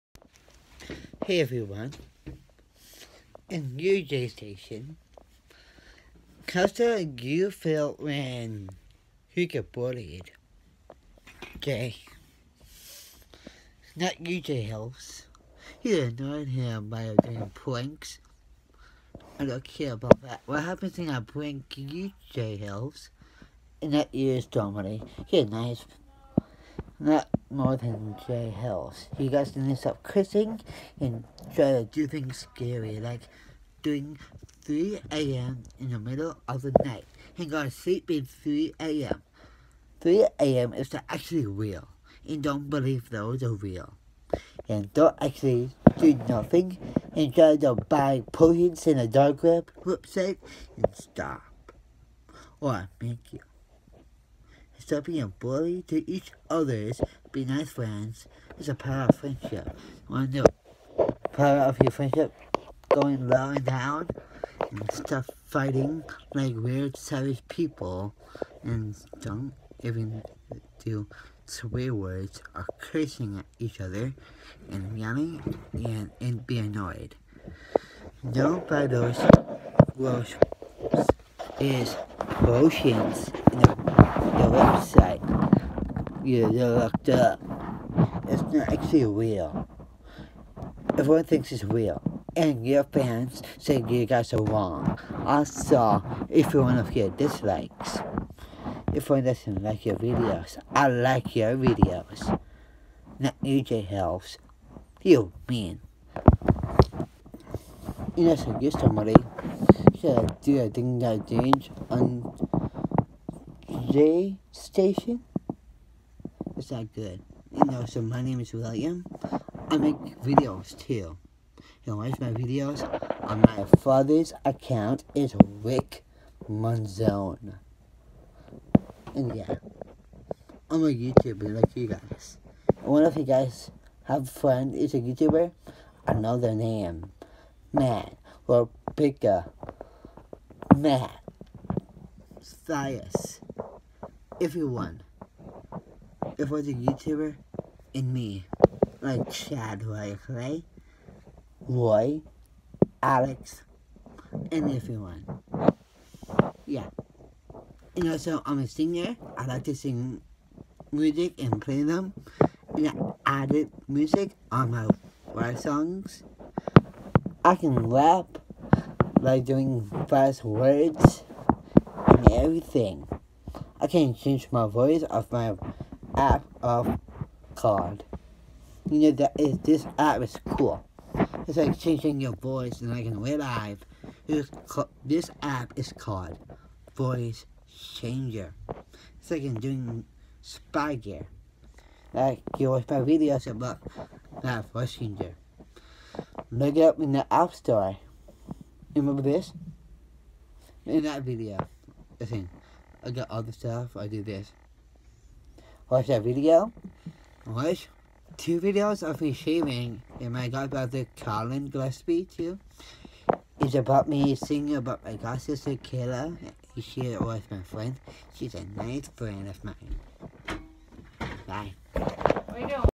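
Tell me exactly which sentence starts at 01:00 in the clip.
Want to know power of your friendship?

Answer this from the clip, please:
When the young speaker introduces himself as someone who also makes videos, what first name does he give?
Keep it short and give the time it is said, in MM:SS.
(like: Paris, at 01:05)
William, at 01:58.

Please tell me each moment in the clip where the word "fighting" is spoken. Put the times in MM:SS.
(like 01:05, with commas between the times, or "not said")
01:05.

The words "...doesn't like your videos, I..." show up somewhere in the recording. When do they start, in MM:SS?
01:39.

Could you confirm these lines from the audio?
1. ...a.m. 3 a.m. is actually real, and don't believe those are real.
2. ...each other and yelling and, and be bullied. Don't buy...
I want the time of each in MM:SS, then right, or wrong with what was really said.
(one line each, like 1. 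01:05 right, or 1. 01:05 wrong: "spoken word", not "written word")
1. 00:38 right
2. 01:13 wrong: "annoyed", not "bullied".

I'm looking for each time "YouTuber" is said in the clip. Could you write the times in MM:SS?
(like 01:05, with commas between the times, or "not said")
02:10, 02:14, 02:26.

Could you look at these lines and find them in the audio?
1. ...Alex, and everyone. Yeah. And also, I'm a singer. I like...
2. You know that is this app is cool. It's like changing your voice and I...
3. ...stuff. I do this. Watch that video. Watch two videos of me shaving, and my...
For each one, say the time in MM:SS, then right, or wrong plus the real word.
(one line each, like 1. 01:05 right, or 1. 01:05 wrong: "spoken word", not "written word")
1. 02:33 right
2. 02:58 right
3. 03:23 right.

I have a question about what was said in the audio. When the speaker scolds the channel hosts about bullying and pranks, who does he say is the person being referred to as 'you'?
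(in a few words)
Dominic.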